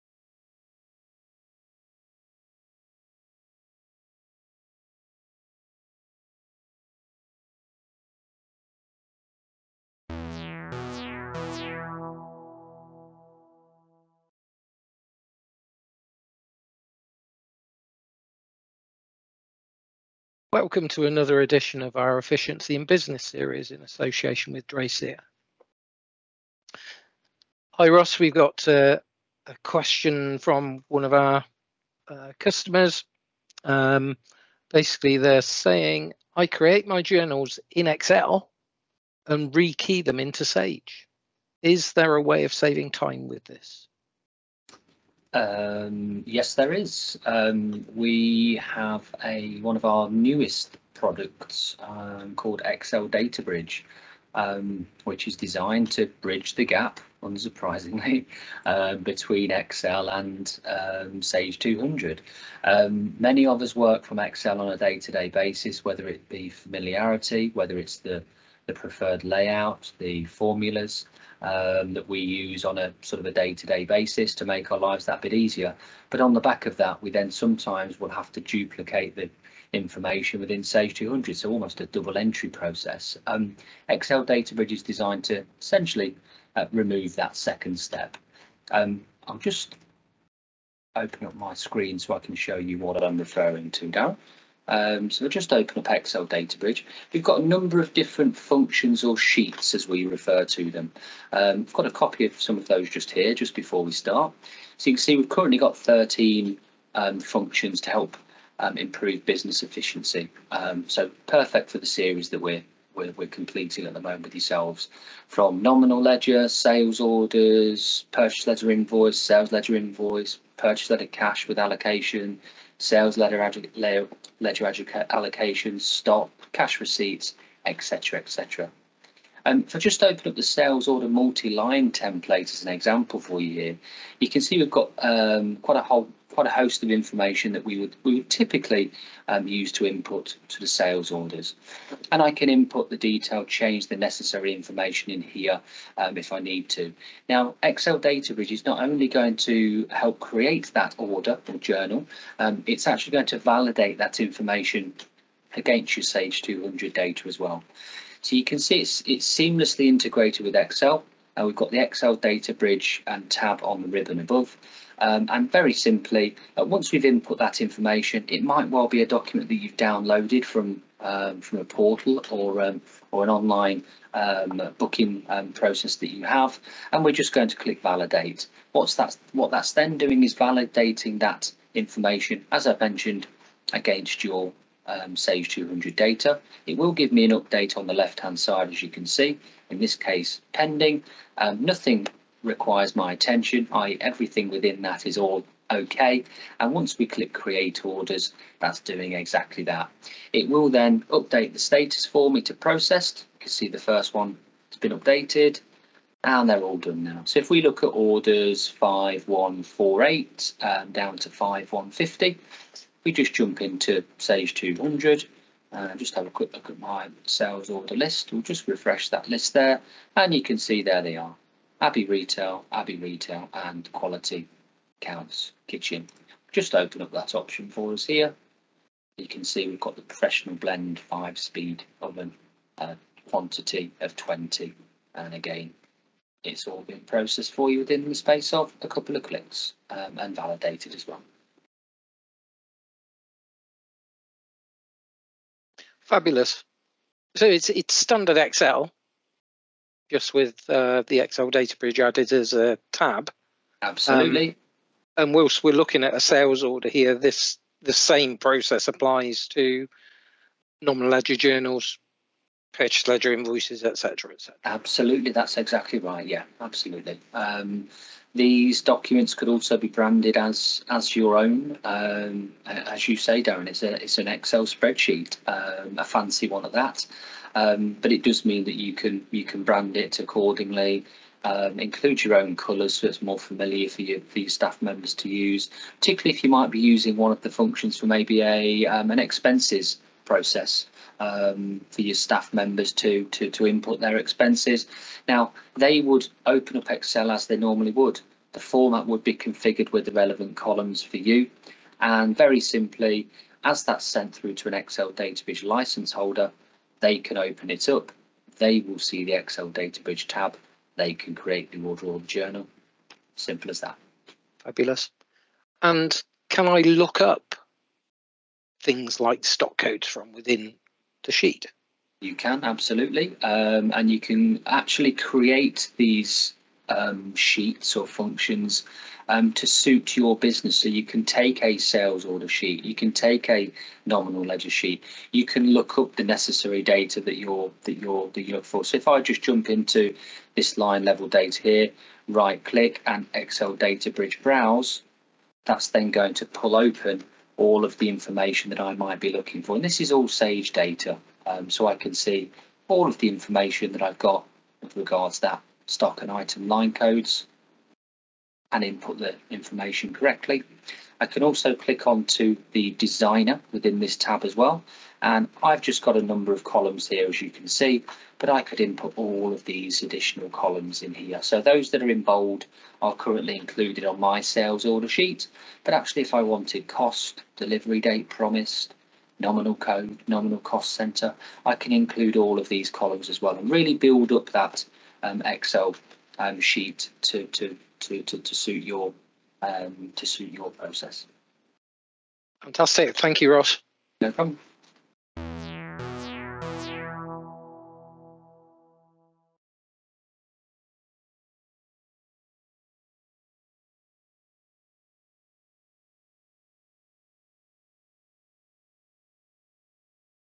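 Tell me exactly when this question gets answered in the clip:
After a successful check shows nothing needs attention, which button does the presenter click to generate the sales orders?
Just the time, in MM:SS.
03:17.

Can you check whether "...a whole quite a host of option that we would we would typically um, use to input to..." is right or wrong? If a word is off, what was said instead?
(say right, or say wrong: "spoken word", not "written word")
wrong: "information", not "option".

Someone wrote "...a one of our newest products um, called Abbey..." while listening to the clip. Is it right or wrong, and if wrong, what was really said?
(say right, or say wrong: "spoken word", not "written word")
wrong: "Excel", not "Abbey".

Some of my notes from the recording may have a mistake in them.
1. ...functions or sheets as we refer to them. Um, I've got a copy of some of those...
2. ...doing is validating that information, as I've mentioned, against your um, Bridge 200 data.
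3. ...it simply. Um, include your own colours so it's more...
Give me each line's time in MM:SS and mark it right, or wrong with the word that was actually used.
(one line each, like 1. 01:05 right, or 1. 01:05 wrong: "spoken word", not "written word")
1. 01:38 right
2. 02:59 wrong: "Sage", not "Bridge"
3. 04:39 wrong: "accordingly", not "simply".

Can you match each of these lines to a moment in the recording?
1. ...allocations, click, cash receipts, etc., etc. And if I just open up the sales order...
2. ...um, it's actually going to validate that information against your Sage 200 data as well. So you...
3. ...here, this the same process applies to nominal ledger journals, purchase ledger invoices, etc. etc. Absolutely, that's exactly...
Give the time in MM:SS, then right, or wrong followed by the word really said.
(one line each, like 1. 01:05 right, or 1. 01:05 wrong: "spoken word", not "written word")
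1. 02:04 wrong: "stock", not "click"
2. 02:32 right
3. 04:16 right.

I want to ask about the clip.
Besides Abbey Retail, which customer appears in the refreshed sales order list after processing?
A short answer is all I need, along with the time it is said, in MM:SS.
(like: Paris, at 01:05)
Quality Counts Kitchen, at 03:43.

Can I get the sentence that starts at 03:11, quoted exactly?
Um, nothing requires my attention, i.e.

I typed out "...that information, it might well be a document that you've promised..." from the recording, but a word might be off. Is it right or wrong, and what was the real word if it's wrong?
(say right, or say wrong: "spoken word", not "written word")
wrong: "downloaded", not "promised".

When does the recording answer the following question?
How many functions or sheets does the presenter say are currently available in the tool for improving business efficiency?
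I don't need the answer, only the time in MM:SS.
01:45.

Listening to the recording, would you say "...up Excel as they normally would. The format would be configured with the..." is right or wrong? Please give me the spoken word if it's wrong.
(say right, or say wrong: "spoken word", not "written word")
right.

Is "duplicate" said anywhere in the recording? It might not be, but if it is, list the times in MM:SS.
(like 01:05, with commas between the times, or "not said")
01:18.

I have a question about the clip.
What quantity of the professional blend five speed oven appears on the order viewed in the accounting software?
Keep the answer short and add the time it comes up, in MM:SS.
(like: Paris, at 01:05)
20, at 03:54.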